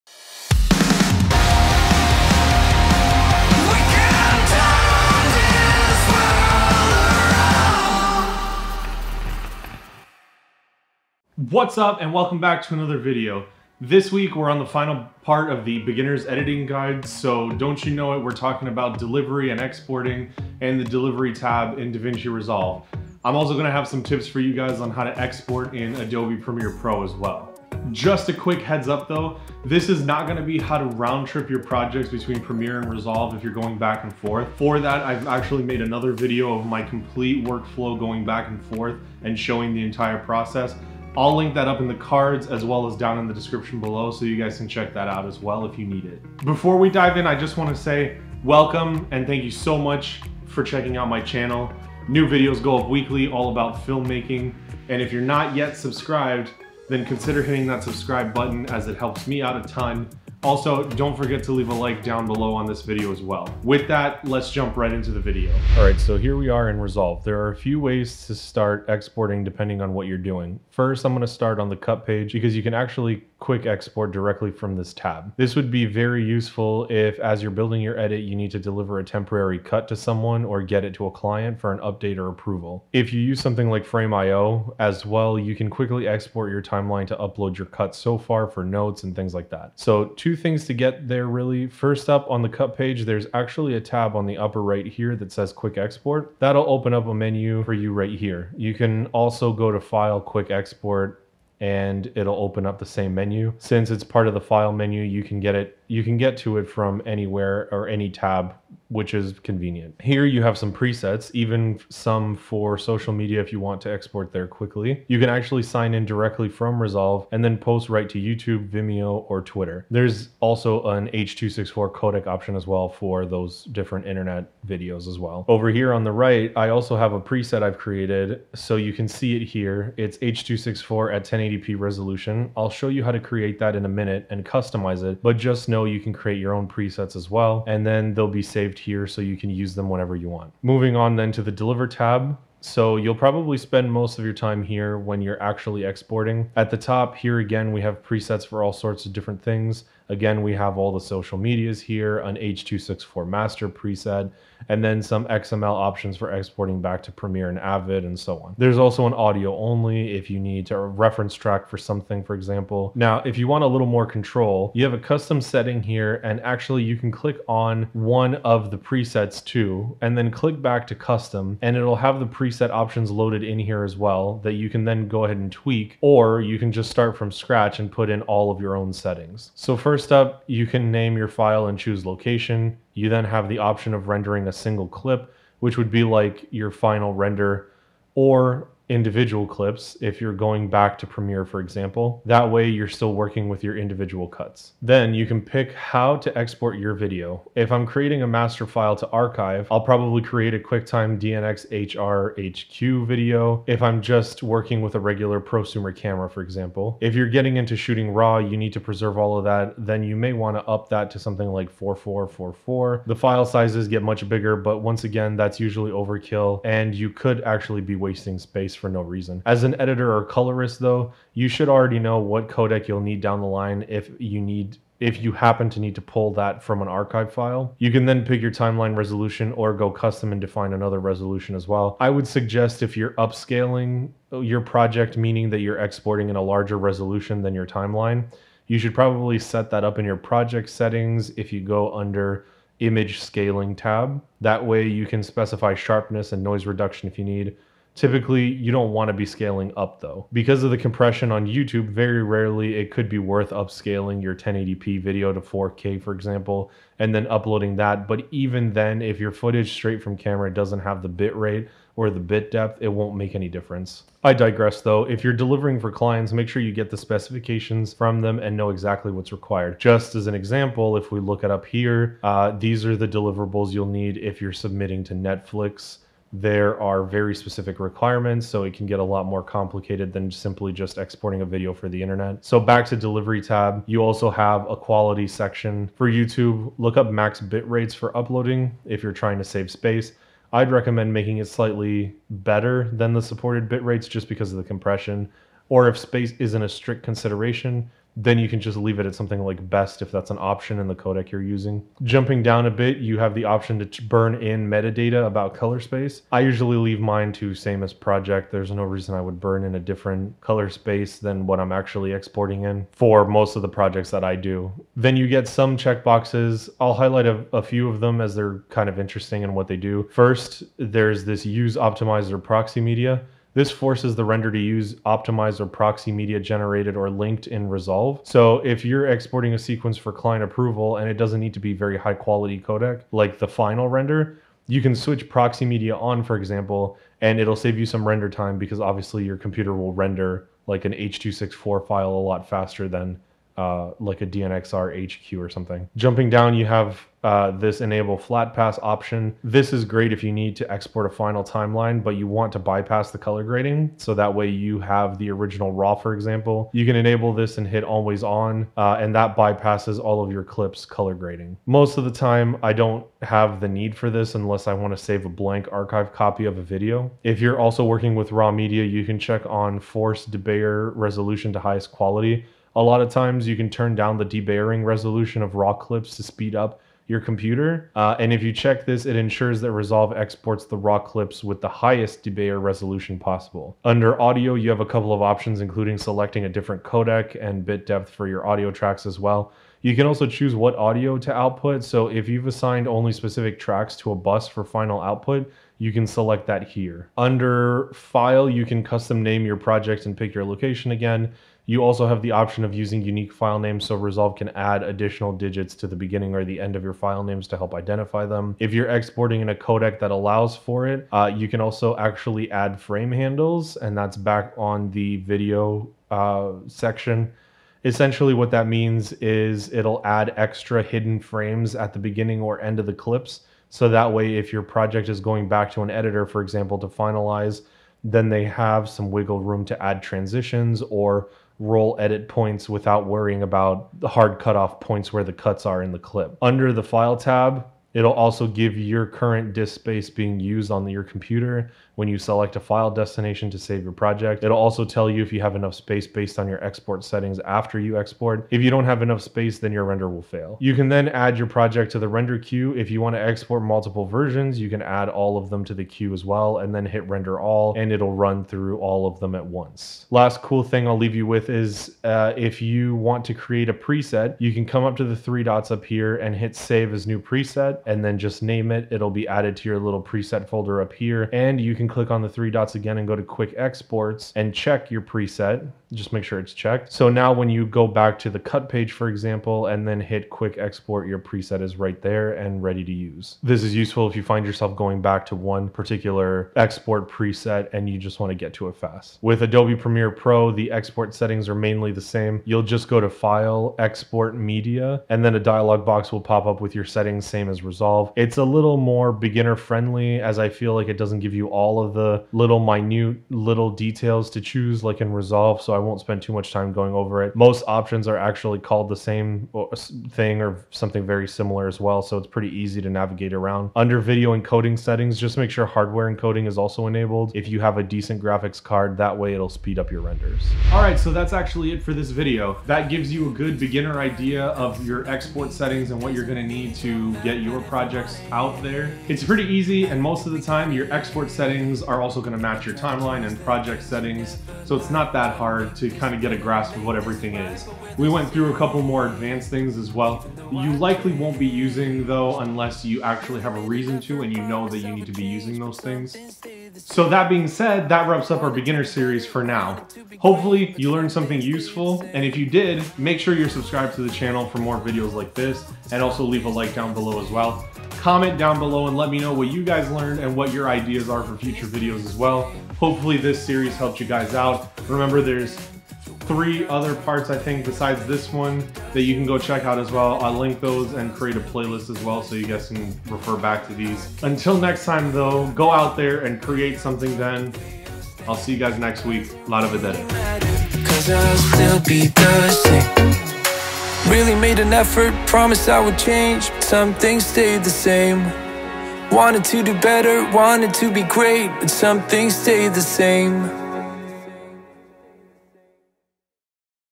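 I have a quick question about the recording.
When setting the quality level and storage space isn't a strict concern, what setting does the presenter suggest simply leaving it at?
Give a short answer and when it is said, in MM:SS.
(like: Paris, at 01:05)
best, at 04:59.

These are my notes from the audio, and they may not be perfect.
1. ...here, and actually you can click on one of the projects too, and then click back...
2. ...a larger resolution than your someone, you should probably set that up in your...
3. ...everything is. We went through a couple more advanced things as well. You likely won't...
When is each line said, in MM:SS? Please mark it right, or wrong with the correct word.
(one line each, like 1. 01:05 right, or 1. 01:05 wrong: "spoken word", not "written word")
1. 02:45 wrong: "presets", not "projects"
2. 03:56 wrong: "timeline", not "someone"
3. 08:56 right.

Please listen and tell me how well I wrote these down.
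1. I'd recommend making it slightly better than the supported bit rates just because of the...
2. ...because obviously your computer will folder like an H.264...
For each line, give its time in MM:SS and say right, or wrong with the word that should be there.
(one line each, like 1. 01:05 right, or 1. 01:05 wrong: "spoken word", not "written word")
1. 04:50 right
2. 05:38 wrong: "render", not "folder".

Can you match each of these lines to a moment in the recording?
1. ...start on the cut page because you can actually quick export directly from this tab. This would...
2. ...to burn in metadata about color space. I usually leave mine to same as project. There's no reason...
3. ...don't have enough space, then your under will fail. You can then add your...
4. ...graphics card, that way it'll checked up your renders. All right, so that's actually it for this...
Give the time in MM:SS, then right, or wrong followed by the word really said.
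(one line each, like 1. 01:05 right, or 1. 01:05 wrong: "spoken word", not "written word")
1. 01:11 right
2. 05:03 right
3. 07:28 wrong: "render", not "under"
4. 08:38 wrong: "speed", not "checked".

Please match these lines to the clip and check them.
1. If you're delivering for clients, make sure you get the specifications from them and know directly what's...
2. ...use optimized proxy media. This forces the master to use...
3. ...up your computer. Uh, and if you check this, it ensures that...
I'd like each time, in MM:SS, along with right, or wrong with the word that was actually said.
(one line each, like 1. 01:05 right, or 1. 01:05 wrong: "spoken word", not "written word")
1. 04:25 wrong: "exactly", not "directly"
2. 05:21 wrong: "render", not "master"
3. 06:16 right.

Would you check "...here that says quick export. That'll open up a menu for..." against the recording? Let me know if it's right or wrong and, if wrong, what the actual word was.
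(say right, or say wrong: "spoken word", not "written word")
right.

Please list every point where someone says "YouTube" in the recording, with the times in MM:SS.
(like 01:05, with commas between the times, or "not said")
01:58, 04:11, 04:46.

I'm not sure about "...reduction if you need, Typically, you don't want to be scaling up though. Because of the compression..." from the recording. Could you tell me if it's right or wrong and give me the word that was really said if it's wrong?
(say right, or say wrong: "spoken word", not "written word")
right.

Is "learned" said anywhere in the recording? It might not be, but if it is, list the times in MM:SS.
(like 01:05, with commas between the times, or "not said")
09:10, 09:19.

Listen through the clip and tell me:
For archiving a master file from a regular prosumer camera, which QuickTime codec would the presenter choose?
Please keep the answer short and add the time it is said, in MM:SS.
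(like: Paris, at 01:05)
DNxHR HQ, at 03:21.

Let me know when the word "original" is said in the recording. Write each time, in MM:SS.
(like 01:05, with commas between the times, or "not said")
05:55.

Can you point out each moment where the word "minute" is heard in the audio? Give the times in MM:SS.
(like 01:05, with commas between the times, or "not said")
02:13, 08:22.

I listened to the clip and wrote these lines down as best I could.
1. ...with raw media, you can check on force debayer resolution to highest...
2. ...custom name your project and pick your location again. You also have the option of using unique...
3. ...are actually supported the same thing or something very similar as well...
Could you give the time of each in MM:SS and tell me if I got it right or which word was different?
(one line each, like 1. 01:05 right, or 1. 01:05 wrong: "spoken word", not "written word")
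1. 06:08 right
2. 06:38 right
3. 08:28 wrong: "called", not "supported".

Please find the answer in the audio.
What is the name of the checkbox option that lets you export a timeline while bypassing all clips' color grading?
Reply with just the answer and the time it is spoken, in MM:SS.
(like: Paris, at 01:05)
enable flat pass, at 05:47.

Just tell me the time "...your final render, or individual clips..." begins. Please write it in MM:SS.
03:06.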